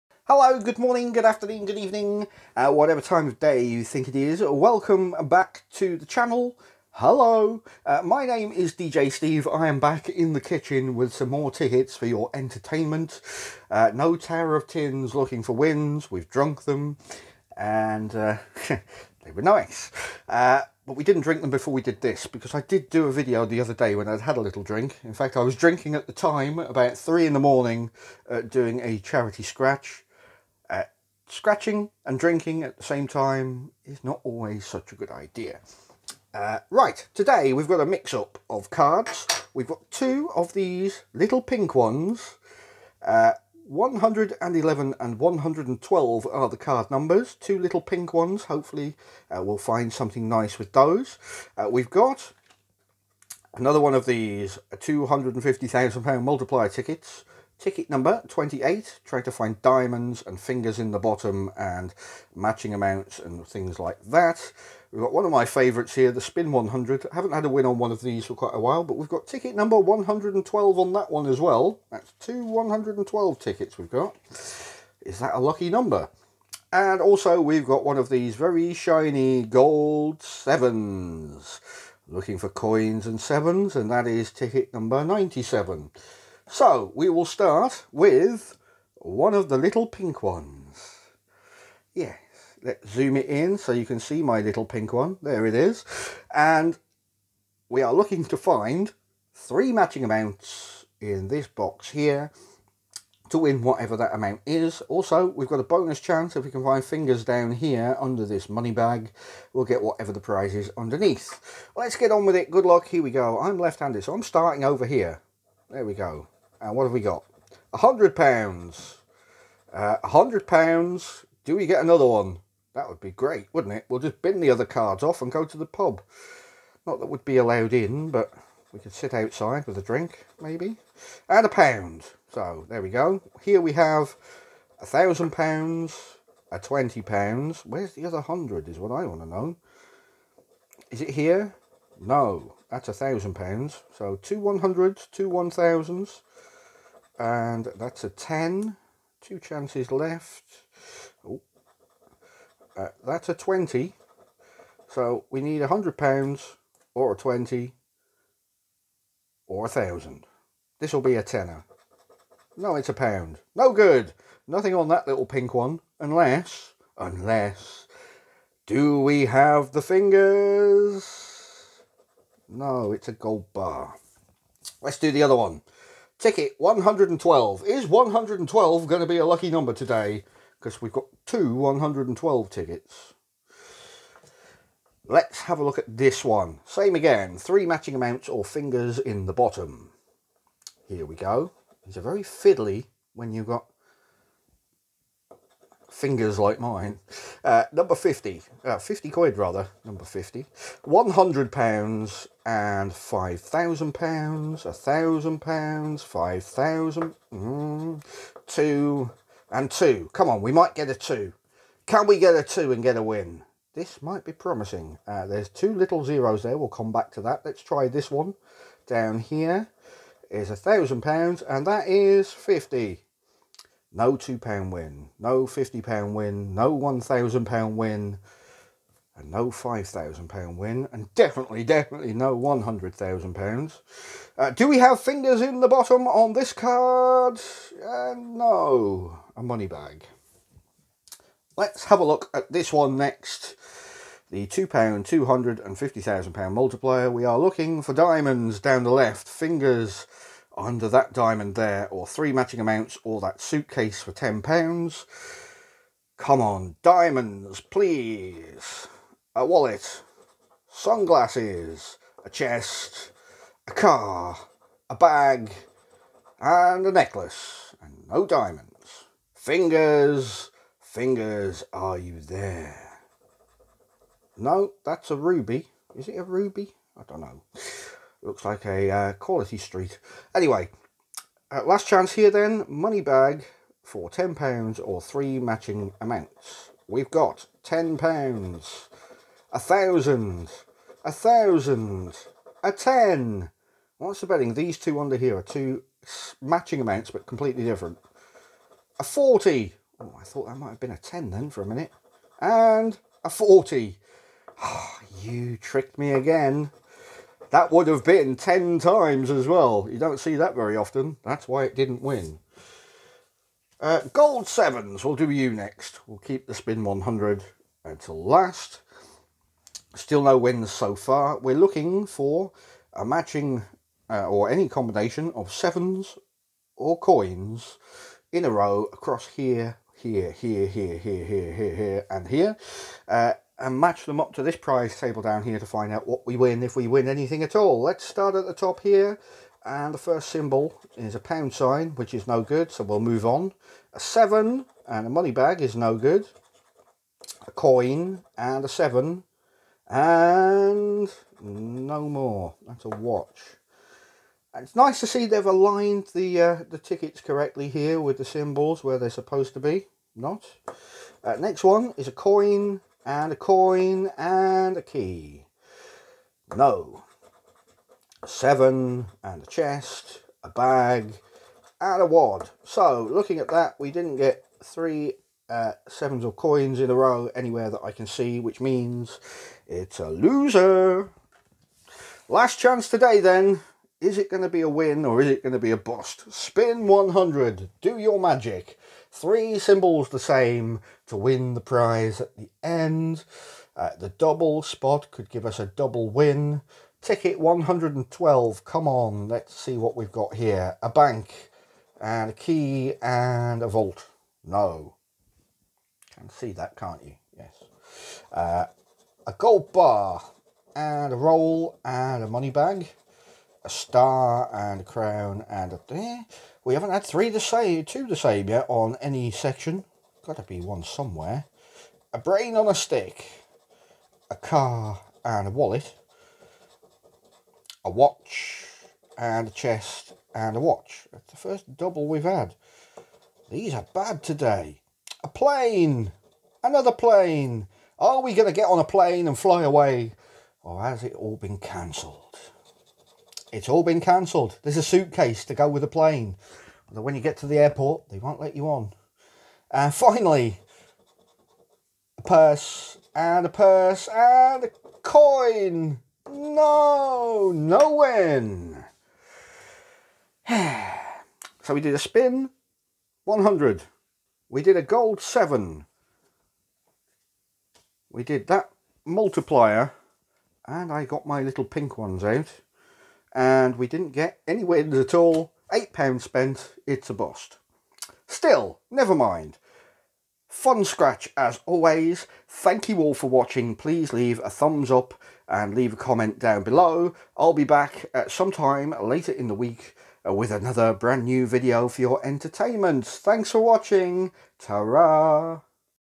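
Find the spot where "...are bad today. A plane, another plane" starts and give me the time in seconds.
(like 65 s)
433 s.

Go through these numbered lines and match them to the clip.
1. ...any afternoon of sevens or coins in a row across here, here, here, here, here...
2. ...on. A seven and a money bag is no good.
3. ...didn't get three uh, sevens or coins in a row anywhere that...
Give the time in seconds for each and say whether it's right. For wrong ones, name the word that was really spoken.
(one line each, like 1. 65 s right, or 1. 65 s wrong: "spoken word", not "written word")
1. 324 s wrong: "combination", not "afternoon"
2. 343 s right
3. 373 s right.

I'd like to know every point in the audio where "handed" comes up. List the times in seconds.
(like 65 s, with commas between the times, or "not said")
113 s.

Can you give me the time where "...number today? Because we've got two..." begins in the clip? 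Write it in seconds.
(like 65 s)
179 s.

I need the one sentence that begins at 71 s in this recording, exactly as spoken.
That's two 112 tickets we've got.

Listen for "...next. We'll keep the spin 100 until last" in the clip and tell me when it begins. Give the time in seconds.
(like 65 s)
315 s.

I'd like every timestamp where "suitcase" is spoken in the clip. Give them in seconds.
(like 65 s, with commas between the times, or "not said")
253 s, 444 s.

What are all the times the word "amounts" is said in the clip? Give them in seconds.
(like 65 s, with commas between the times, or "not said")
62 s, 100 s, 104 s, 187 s, 252 s, 285 s, 296 s.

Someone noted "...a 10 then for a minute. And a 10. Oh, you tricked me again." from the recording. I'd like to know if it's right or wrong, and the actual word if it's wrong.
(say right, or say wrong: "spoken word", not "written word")
wrong: "40", not "10".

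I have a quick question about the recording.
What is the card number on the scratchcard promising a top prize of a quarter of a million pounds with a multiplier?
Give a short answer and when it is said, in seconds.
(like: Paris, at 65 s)
28, at 57 s.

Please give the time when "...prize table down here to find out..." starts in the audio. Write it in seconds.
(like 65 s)
334 s.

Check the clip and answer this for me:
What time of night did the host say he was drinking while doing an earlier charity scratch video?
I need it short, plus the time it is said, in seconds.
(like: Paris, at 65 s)
3 in the morning, at 26 s.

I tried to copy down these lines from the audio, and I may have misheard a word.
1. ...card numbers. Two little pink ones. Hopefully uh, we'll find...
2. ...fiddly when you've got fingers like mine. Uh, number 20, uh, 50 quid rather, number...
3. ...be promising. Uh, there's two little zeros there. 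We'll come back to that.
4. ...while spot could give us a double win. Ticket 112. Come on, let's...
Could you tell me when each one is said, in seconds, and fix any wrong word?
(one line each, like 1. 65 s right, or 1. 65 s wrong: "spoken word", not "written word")
1. 46 s right
2. 192 s wrong: "50", not "20"
3. 214 s right
4. 394 s wrong: "double", not "while".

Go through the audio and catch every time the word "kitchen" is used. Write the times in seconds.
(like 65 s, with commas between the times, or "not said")
10 s.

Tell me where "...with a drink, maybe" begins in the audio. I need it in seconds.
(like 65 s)
129 s.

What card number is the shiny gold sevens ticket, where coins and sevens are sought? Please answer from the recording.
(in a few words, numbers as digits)
97.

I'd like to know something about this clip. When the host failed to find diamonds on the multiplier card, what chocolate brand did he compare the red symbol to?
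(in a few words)
Quality Street.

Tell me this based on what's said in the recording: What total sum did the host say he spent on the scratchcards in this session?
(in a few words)
£8.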